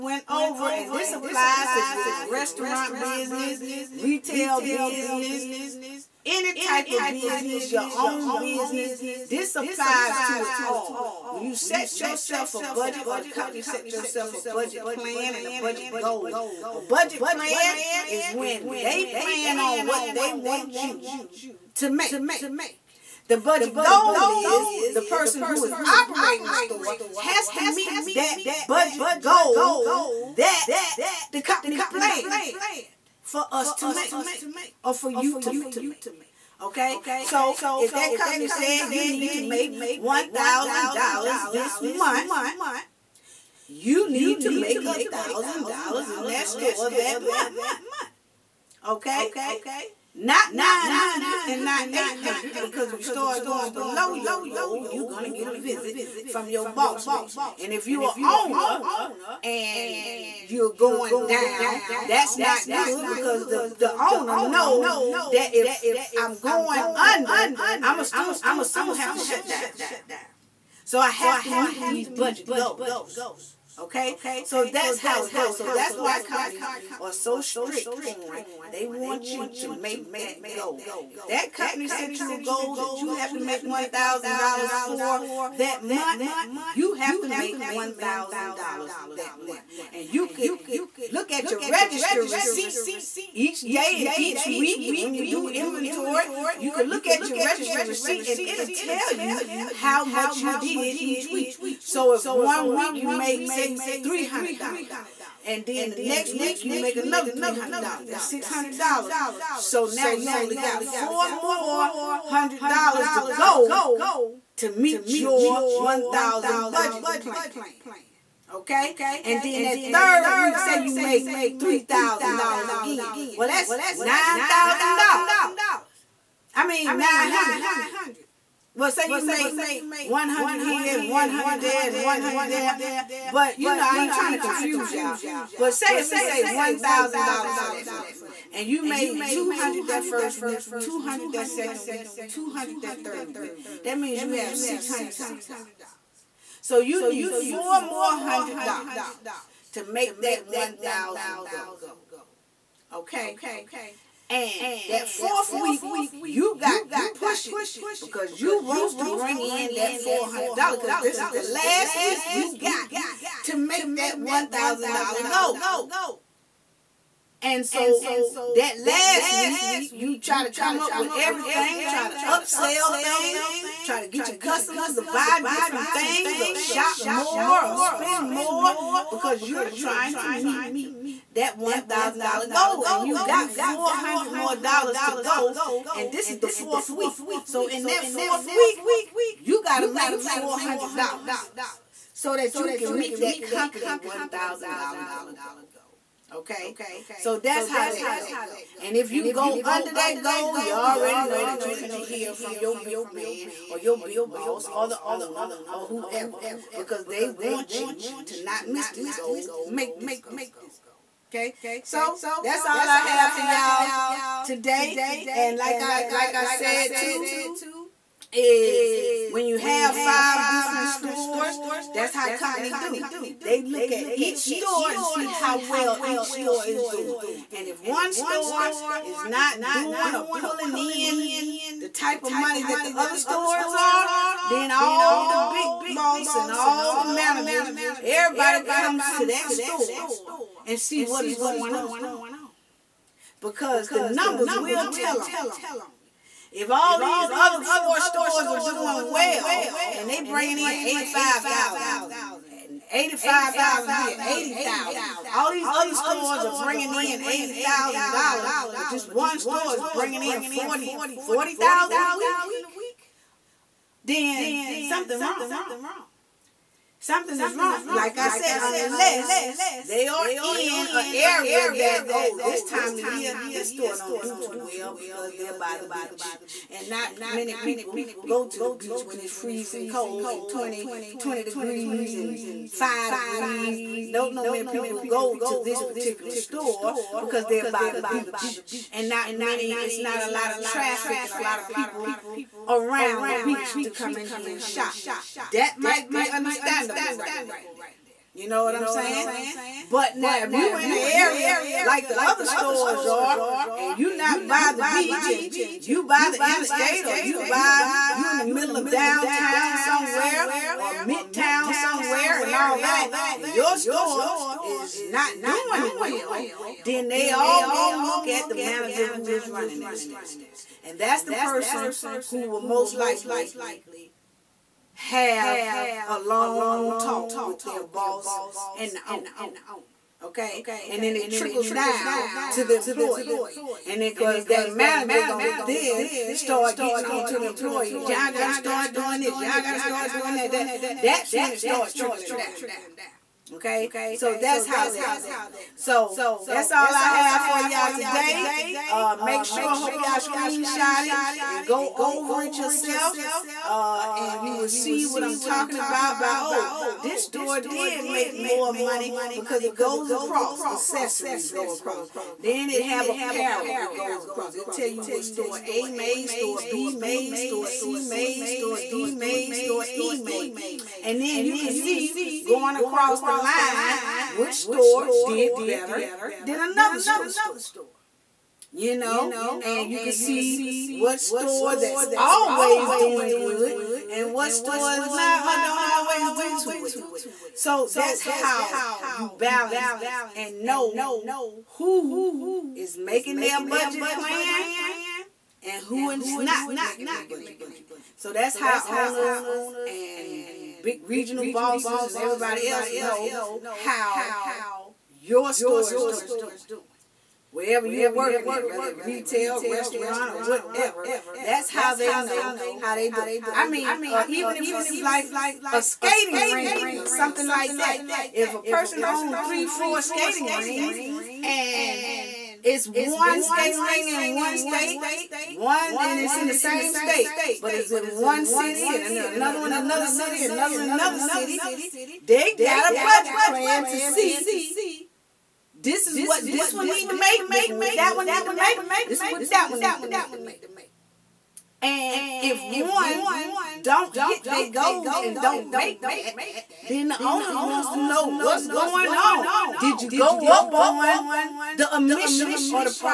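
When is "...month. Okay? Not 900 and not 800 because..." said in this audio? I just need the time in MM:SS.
00:47.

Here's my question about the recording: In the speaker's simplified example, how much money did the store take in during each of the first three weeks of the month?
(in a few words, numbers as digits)
$200.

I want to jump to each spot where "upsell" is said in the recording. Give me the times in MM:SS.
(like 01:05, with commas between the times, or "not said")
02:52.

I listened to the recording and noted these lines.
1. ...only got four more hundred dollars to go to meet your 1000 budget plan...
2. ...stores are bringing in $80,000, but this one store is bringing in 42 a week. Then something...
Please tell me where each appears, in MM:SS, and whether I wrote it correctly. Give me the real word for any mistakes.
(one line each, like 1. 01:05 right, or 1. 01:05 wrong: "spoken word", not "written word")
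1. 01:50 right
2. 04:15 wrong: "40", not "42".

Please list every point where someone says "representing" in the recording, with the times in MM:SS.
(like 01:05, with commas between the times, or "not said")
not said.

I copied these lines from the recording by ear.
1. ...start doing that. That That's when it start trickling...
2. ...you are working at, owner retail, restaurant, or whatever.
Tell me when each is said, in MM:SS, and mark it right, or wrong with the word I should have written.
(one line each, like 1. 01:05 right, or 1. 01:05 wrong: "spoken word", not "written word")
1. 05:39 right
2. 06:47 wrong: "whether", not "owner".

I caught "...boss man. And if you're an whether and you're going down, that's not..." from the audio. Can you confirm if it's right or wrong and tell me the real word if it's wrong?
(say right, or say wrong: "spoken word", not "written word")
wrong: "owner", not "whether".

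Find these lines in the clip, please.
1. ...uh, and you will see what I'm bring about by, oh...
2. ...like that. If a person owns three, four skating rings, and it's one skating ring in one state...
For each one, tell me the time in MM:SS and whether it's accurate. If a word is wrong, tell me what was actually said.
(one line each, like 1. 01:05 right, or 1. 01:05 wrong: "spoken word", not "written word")
1. 05:53 wrong: "talking", not "bring"
2. 06:57 right.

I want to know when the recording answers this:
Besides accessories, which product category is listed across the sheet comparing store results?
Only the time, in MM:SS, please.
06:03.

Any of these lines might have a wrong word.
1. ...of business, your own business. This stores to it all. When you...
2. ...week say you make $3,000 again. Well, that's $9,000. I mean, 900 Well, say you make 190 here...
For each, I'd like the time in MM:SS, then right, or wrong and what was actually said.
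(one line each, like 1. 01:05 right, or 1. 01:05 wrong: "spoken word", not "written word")
1. 00:06 wrong: "applies", not "stores"
2. 02:00 wrong: "100", not "190".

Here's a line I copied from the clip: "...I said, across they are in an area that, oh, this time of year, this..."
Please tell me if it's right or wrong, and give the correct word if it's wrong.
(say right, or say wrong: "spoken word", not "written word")
wrong: "unless", not "across".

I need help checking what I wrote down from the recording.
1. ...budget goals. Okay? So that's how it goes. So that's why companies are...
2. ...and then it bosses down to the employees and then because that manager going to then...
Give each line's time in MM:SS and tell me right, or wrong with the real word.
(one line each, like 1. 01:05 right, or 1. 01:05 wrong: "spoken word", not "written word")
1. 01:12 right
2. 05:30 wrong: "trickles", not "bosses".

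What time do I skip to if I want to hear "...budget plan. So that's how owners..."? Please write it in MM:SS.
06:37.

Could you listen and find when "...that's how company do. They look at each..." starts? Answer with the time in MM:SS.
03:41.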